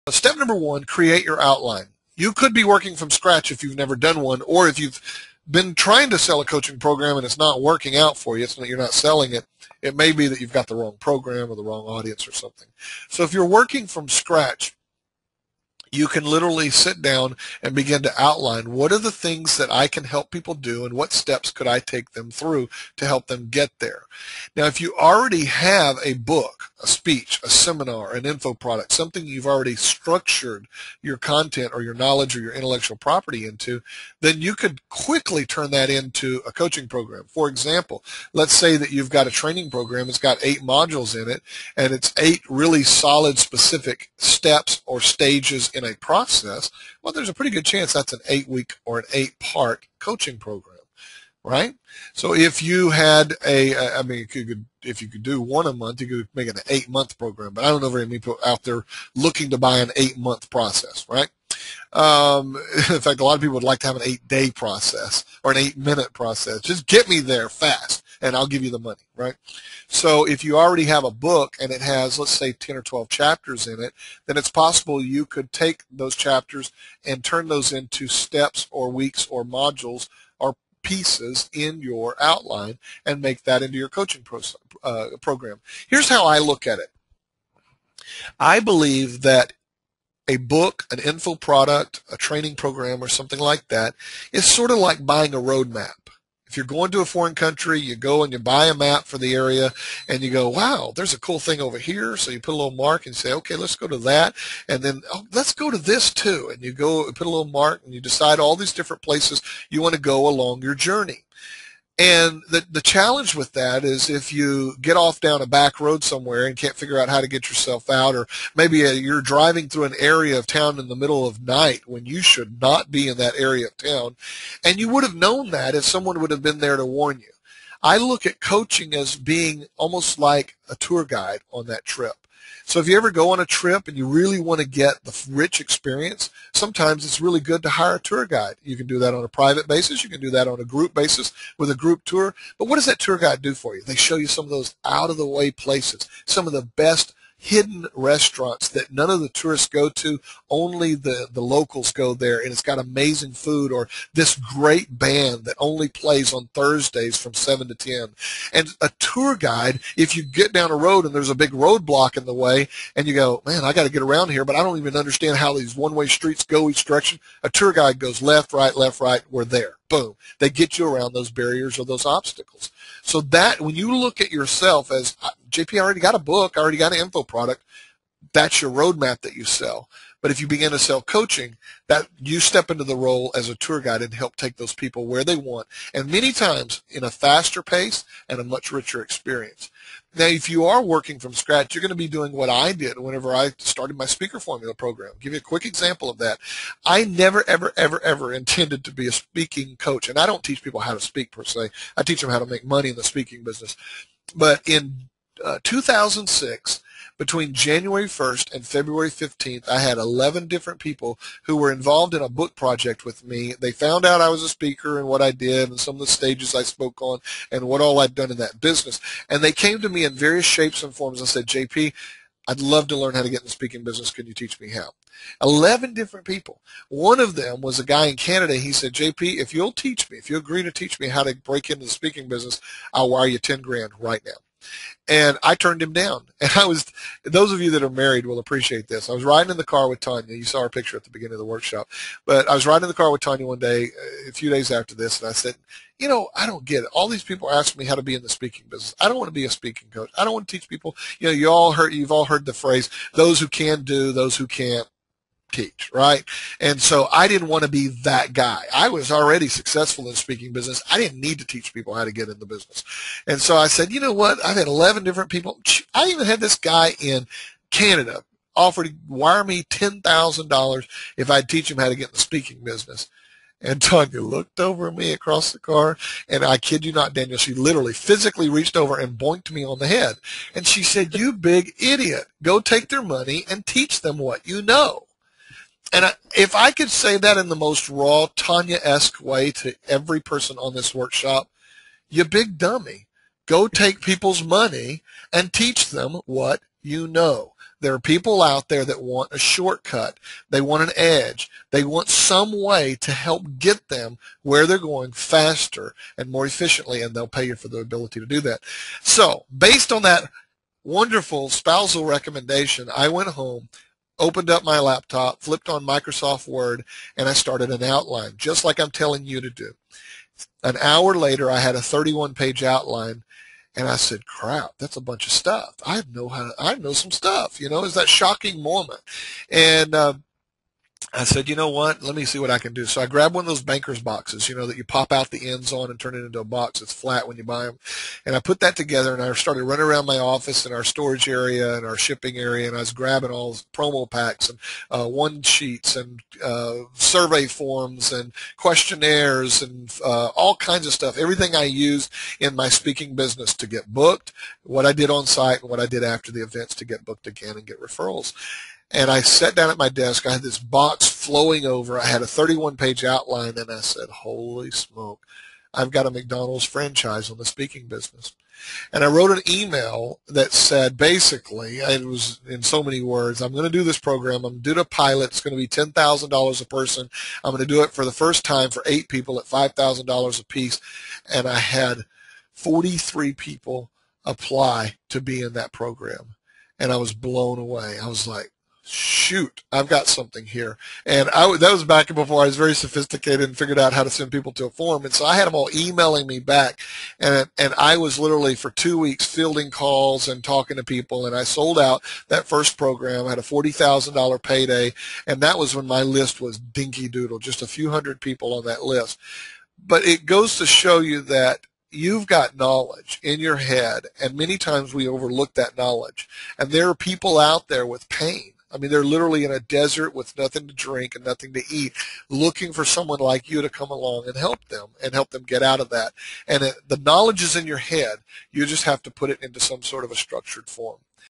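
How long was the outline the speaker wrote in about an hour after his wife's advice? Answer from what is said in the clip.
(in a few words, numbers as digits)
31 pages.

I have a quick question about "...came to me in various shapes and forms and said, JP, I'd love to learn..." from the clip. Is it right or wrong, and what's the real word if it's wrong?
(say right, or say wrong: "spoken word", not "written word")
right.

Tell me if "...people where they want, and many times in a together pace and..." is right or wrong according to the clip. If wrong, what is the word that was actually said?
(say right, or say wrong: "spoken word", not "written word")
wrong: "faster", not "together".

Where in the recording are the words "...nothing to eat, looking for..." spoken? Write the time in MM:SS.
07:01.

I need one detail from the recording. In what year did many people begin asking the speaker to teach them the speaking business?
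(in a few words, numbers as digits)
2006.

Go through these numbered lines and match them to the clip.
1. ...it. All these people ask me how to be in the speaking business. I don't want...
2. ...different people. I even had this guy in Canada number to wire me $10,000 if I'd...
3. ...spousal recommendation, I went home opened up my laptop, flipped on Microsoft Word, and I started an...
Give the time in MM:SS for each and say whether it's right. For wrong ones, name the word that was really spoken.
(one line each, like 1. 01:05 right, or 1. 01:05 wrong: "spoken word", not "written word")
1. 04:06 right
2. 04:25 wrong: "offer", not "number"
3. 05:11 right.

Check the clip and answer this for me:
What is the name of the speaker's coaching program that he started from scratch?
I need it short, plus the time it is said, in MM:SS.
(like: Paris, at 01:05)
speaker formula, at 03:14.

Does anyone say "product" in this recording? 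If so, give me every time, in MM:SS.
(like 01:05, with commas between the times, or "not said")
00:28, 01:31, 02:57.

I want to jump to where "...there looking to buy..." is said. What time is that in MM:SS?
00:58.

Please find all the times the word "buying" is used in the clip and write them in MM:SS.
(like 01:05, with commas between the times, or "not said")
01:35.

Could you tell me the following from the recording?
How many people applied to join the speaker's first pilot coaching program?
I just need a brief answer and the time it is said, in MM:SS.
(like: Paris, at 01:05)
43, at 06:22.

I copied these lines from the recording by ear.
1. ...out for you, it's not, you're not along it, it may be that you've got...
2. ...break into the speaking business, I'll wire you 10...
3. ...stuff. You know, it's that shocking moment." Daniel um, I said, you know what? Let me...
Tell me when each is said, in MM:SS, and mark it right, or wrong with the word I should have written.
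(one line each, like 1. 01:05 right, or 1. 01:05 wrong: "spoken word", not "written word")
1. 00:07 wrong: "selling", not "along"
2. 03:51 right
3. 05:27 wrong: "And", not "Daniel".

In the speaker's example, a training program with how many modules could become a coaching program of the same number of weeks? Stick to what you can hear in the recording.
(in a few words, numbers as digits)
8.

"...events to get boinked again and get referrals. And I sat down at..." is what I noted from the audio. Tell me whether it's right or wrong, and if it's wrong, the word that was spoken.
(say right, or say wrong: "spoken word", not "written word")
wrong: "booked", not "boinked".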